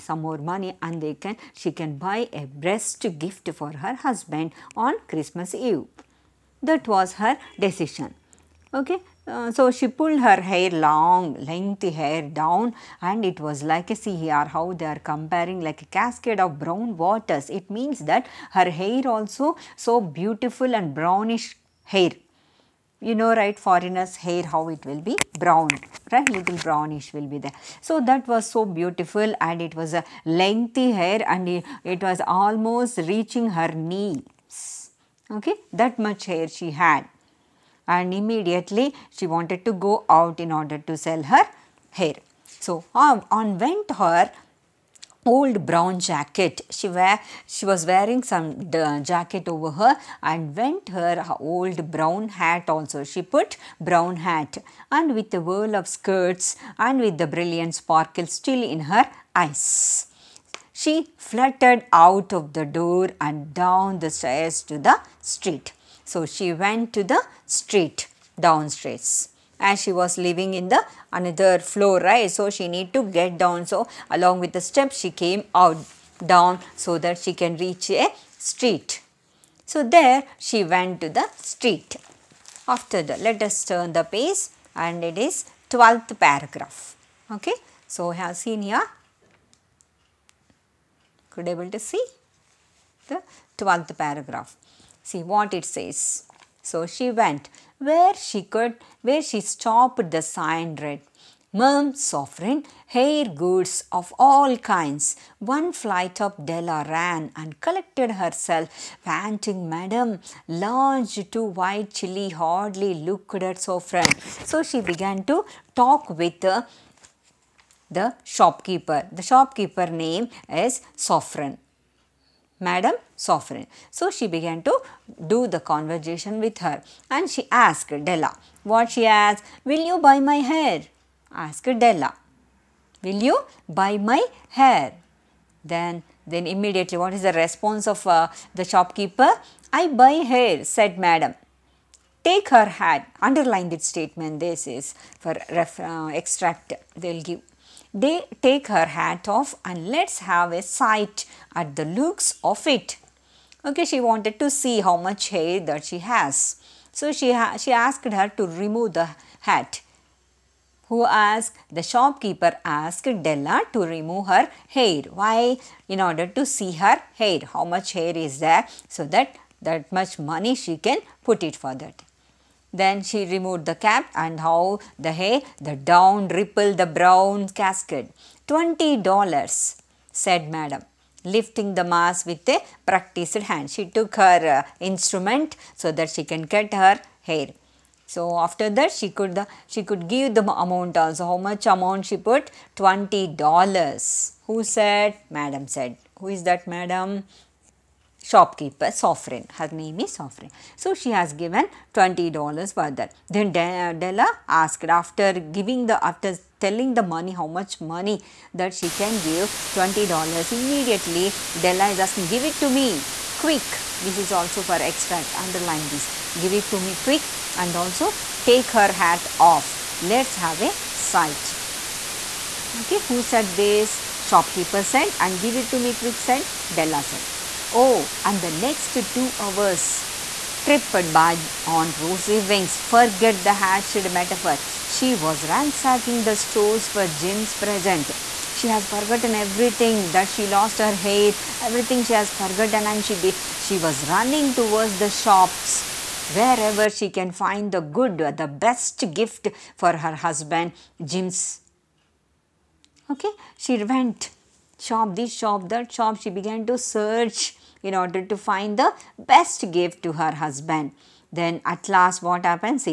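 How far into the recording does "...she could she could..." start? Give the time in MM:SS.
03:08.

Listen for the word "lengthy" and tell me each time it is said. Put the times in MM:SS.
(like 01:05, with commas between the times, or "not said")
00:11, 00:30.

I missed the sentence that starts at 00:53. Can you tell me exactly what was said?
She put brown hat and with the whirl of skirts and with the brilliant sparkle still in her eyes.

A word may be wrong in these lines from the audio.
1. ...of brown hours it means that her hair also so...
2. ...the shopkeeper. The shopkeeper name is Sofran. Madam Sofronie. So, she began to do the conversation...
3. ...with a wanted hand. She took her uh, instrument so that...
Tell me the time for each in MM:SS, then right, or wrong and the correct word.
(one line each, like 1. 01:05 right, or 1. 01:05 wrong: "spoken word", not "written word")
1. 00:16 wrong: "waters", not "hours"
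2. 01:57 right
3. 03:02 wrong: "practiced", not "wanted".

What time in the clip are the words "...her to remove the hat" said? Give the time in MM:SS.
02:38.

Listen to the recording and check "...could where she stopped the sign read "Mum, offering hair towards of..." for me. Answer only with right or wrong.
wrong.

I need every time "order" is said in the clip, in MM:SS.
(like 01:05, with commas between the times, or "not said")
00:40, 02:46, 04:17.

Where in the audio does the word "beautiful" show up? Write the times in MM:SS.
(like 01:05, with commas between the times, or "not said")
00:20, 00:28.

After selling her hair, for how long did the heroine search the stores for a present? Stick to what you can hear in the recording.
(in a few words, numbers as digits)
2 hours.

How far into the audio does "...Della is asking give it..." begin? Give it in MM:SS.
03:31.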